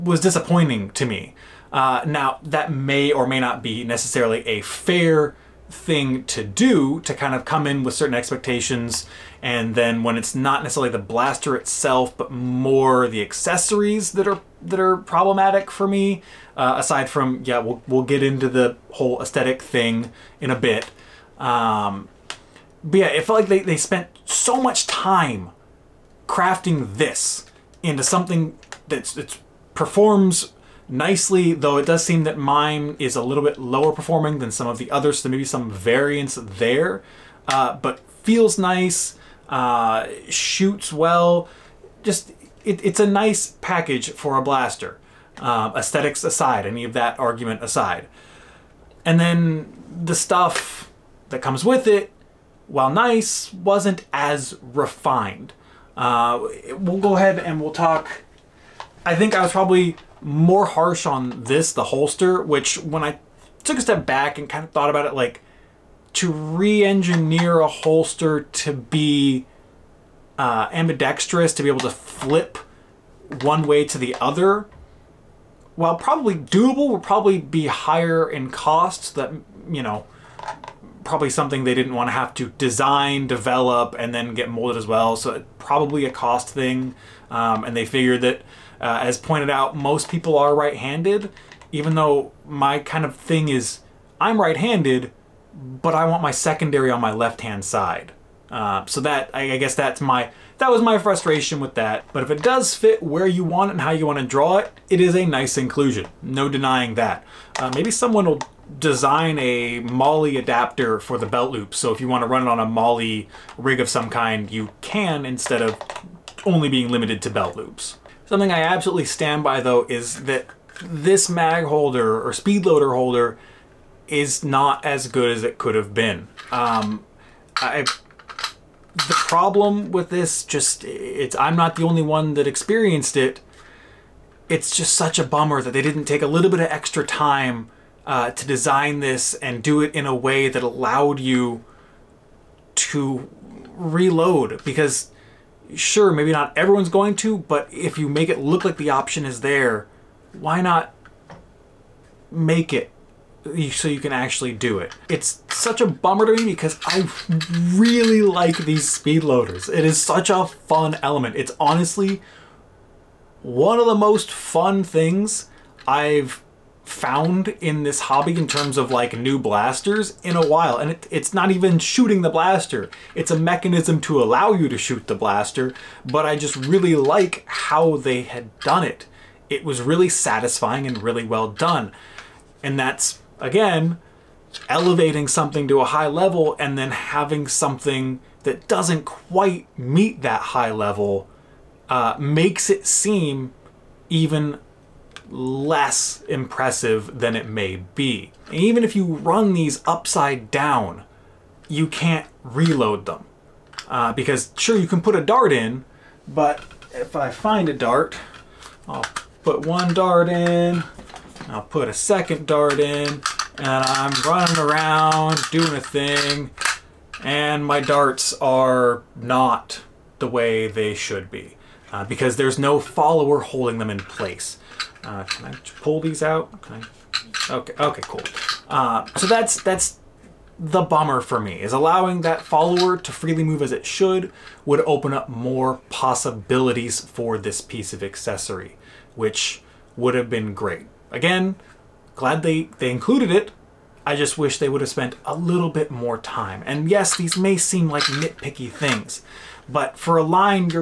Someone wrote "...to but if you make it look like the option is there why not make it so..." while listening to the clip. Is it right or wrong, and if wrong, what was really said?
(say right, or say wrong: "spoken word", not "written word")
right.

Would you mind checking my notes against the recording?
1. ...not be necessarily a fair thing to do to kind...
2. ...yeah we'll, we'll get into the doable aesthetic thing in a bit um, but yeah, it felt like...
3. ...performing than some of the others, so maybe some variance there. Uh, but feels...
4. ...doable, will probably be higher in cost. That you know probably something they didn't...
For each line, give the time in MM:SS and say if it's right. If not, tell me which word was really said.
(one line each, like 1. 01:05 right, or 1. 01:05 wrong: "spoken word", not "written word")
1. 00:03 right
2. 00:17 wrong: "whole", not "doable"
3. 00:33 right
4. 01:16 right.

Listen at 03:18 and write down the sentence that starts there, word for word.
And even if you run these upside down, you can't reload them.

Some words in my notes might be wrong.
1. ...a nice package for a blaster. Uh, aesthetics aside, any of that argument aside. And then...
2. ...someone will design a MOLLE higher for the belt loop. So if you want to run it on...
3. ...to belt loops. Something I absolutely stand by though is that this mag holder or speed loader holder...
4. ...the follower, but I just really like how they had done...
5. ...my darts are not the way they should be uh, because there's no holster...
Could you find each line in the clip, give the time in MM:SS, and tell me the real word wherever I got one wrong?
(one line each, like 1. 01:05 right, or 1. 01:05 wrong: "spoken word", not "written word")
1. 00:42 right
2. 01:47 wrong: "adapter", not "higher"
3. 01:57 right
4. 02:55 wrong: "blaster", not "follower"
5. 03:37 wrong: "follower", not "holster".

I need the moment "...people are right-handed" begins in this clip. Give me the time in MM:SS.
01:30.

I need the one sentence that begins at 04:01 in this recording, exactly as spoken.
Again, glad they, they included it.